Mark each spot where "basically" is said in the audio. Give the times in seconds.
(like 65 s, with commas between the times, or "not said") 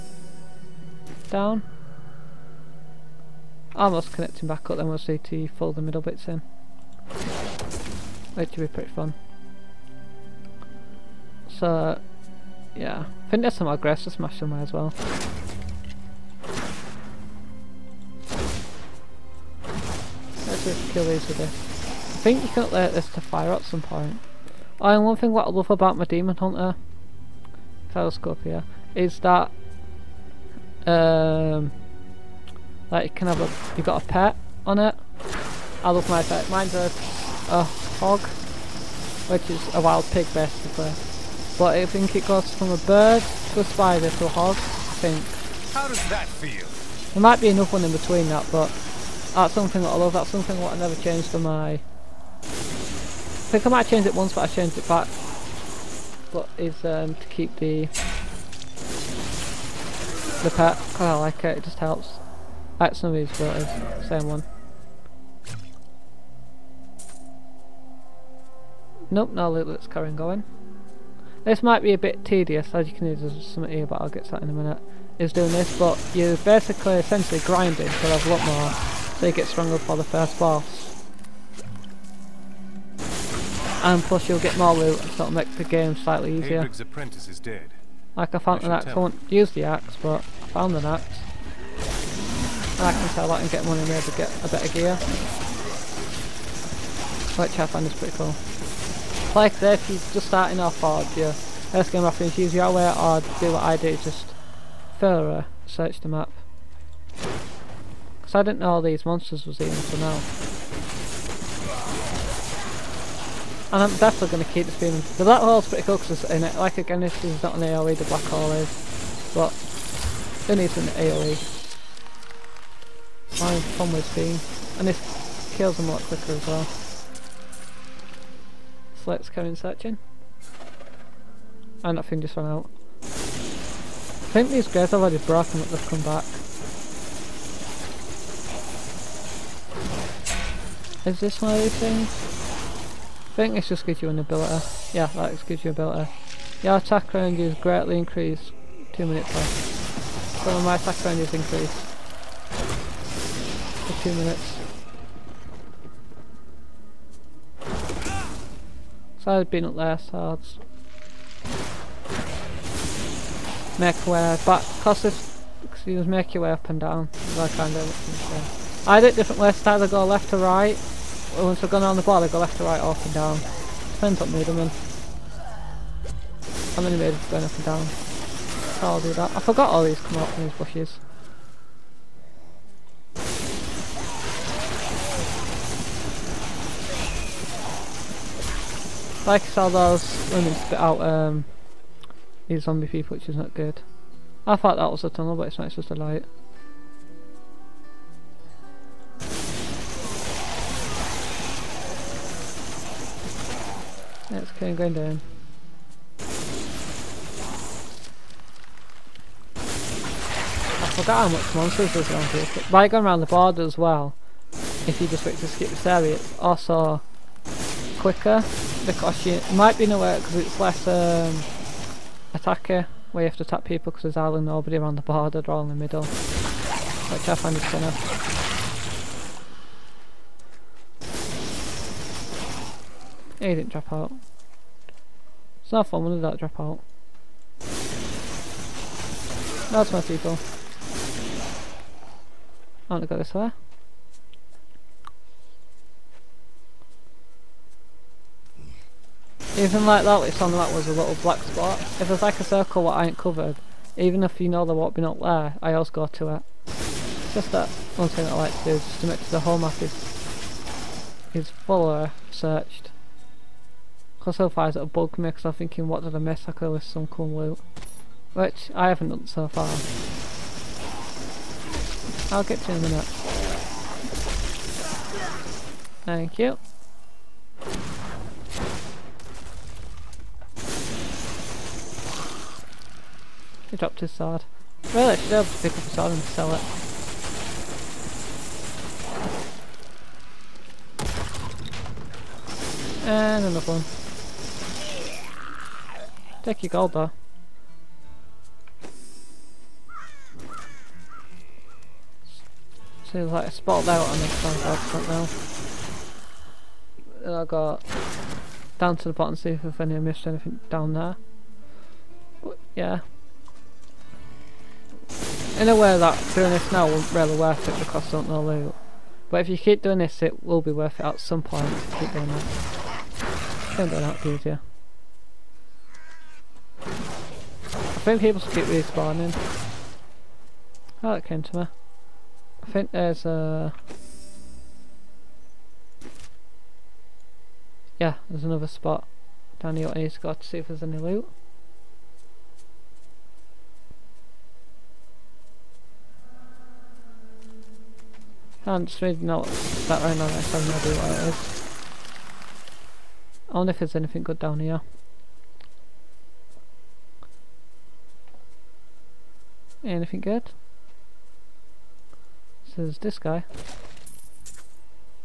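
40 s, 76 s.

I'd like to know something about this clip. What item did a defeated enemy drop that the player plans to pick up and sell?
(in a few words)
A sword.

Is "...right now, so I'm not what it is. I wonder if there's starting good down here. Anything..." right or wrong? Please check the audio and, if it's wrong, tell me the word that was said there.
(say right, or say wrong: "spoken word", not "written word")
wrong: "anything", not "starting".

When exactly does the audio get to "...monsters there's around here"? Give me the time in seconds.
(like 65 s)
211 s.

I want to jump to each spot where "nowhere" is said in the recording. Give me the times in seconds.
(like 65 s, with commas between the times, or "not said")
219 s.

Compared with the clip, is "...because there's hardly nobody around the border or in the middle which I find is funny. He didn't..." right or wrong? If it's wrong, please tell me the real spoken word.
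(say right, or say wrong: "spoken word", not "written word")
right.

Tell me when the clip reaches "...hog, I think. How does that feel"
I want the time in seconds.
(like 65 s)
44 s.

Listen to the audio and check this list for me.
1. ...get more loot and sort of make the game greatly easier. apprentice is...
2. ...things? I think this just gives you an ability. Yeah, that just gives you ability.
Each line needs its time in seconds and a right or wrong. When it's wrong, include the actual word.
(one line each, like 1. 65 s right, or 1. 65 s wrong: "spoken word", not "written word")
1. 84 s wrong: "slightly", not "greatly"
2. 141 s right.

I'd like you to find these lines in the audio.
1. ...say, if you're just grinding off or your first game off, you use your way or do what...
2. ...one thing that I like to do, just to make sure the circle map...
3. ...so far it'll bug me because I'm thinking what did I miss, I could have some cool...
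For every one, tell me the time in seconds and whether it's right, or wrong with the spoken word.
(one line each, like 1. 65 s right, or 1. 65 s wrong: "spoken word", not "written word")
1. 99 s wrong: "starting", not "grinding"
2. 257 s wrong: "whole", not "circle"
3. 264 s right.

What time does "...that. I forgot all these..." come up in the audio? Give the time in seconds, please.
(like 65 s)
179 s.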